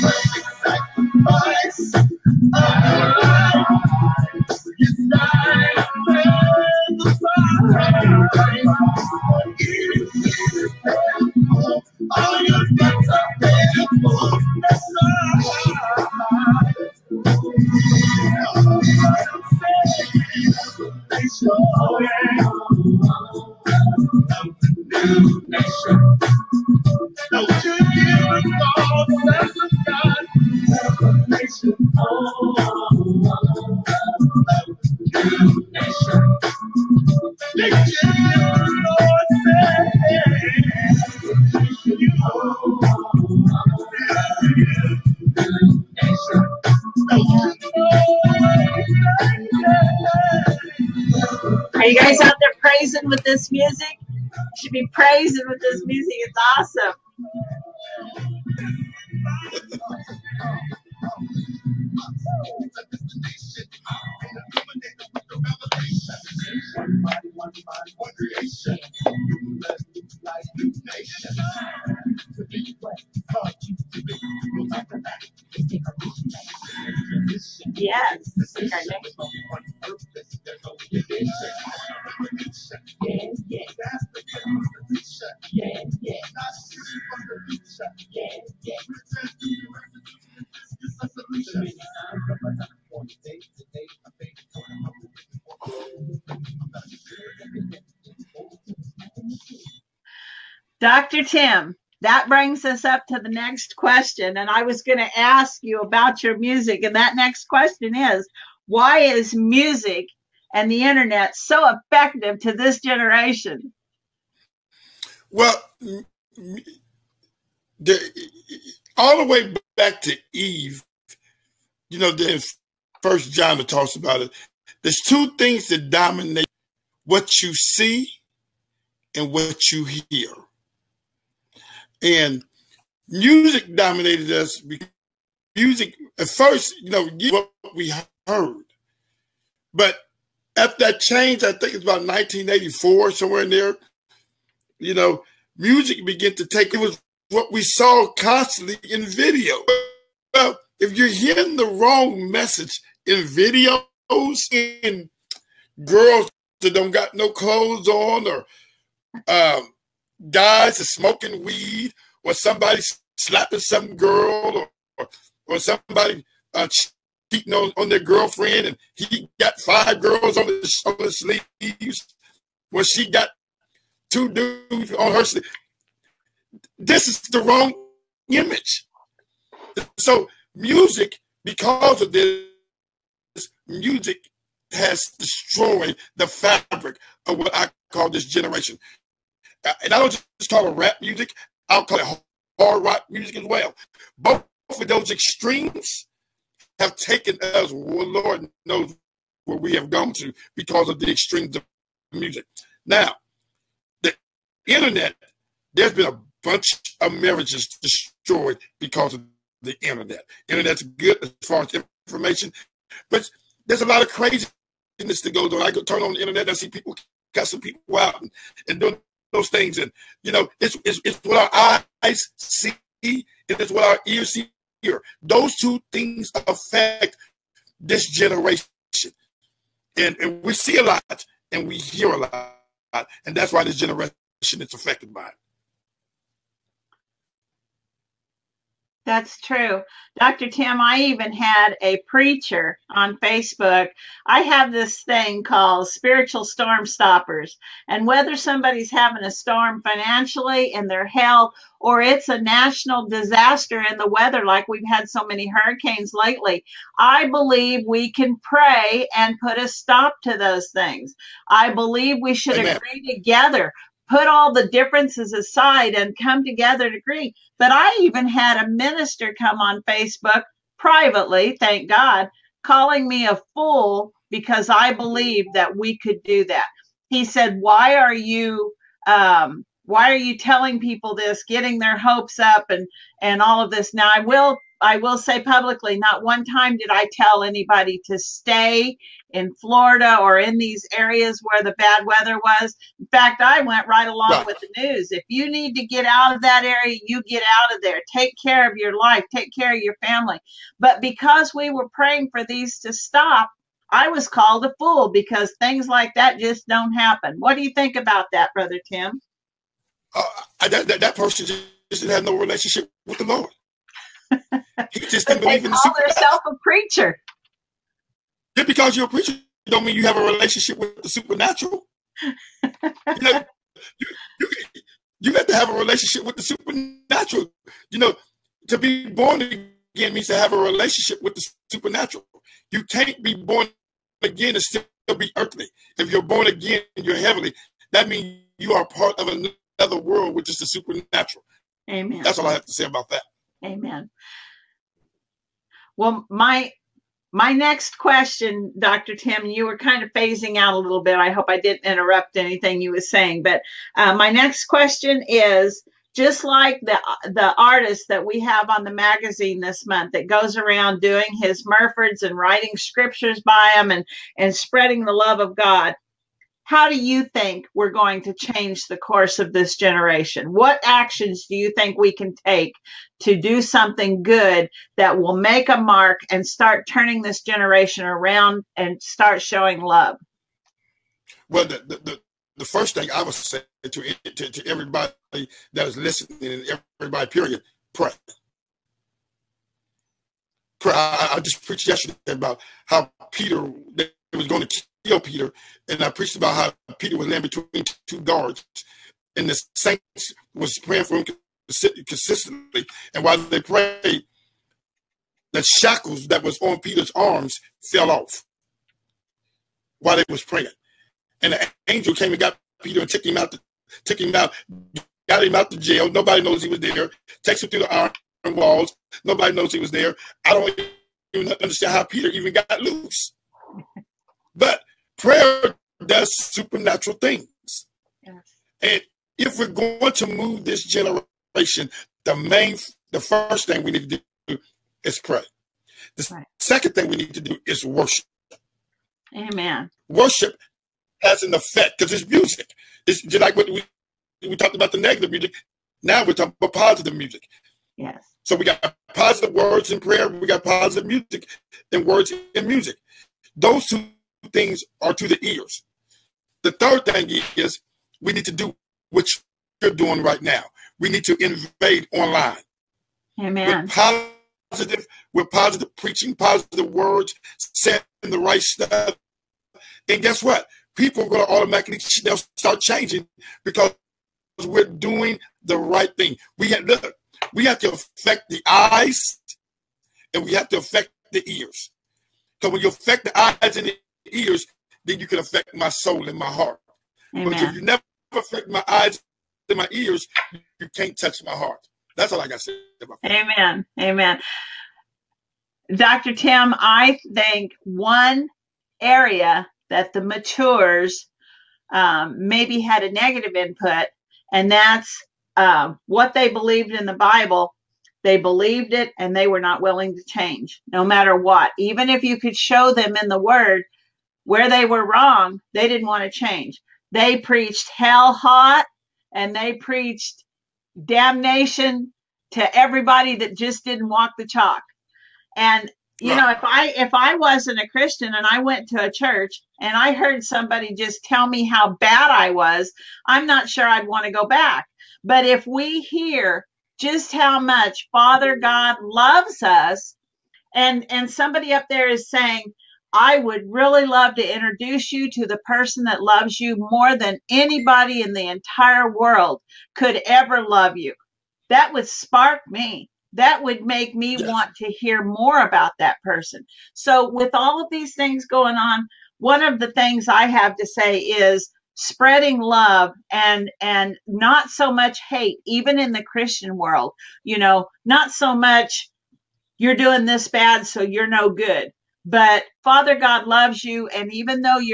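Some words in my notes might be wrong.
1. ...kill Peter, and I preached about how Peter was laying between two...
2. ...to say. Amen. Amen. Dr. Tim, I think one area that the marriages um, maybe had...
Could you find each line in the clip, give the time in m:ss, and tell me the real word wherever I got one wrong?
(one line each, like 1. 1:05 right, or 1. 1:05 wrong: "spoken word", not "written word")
1. 6:35 right
2. 8:12 wrong: "matures", not "marriages".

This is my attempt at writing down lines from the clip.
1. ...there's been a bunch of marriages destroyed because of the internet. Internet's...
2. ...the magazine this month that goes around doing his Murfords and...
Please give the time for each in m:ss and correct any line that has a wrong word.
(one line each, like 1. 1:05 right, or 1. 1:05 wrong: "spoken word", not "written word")
1. 3:25 right
2. 5:58 right.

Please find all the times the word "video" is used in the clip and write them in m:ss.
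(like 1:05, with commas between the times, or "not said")
2:29, 2:33.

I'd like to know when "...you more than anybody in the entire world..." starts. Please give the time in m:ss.
9:06.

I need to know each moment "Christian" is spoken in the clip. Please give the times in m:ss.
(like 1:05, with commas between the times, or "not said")
8:47, 9:26.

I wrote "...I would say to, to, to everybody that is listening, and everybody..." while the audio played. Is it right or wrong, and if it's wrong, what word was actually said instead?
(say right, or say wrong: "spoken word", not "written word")
right.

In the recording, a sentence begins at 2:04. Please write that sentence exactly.
There's two things that dominate what you see and what you hear and music dominated us.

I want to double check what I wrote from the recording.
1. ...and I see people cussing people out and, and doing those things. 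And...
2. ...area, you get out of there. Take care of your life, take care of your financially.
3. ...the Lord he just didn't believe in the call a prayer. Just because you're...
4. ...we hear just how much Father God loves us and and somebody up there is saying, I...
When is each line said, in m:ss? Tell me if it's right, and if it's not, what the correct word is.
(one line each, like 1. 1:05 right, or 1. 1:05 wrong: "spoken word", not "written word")
1. 3:36 right
2. 4:56 wrong: "family", not "financially"
3. 5:13 wrong: "preacher", not "prayer"
4. 8:55 right.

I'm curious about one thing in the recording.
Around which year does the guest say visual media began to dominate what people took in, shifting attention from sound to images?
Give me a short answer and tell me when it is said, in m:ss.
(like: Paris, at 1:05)
1984, at 2:22.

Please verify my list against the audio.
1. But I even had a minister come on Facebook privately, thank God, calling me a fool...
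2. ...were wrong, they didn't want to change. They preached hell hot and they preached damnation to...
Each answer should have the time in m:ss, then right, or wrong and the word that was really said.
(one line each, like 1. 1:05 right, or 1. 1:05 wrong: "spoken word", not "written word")
1. 4:27 right
2. 8:34 right.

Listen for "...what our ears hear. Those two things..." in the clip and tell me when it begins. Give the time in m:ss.
3:43.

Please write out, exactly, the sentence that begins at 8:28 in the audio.
They believed it and they were not willing to change, no matter what.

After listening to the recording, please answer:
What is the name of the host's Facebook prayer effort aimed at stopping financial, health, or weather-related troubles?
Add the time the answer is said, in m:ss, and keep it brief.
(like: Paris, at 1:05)
spiritual storm stoppers, at 4:05.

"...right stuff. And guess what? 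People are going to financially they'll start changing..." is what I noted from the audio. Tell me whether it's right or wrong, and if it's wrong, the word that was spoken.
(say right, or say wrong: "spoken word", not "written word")
wrong: "automatically", not "financially".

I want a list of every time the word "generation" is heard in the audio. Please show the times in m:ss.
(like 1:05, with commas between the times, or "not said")
1:52, 3:08, 3:48, 3:53, 6:09, 6:17, 7:10.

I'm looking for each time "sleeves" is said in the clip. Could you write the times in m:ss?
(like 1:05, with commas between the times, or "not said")
2:51, 2:55.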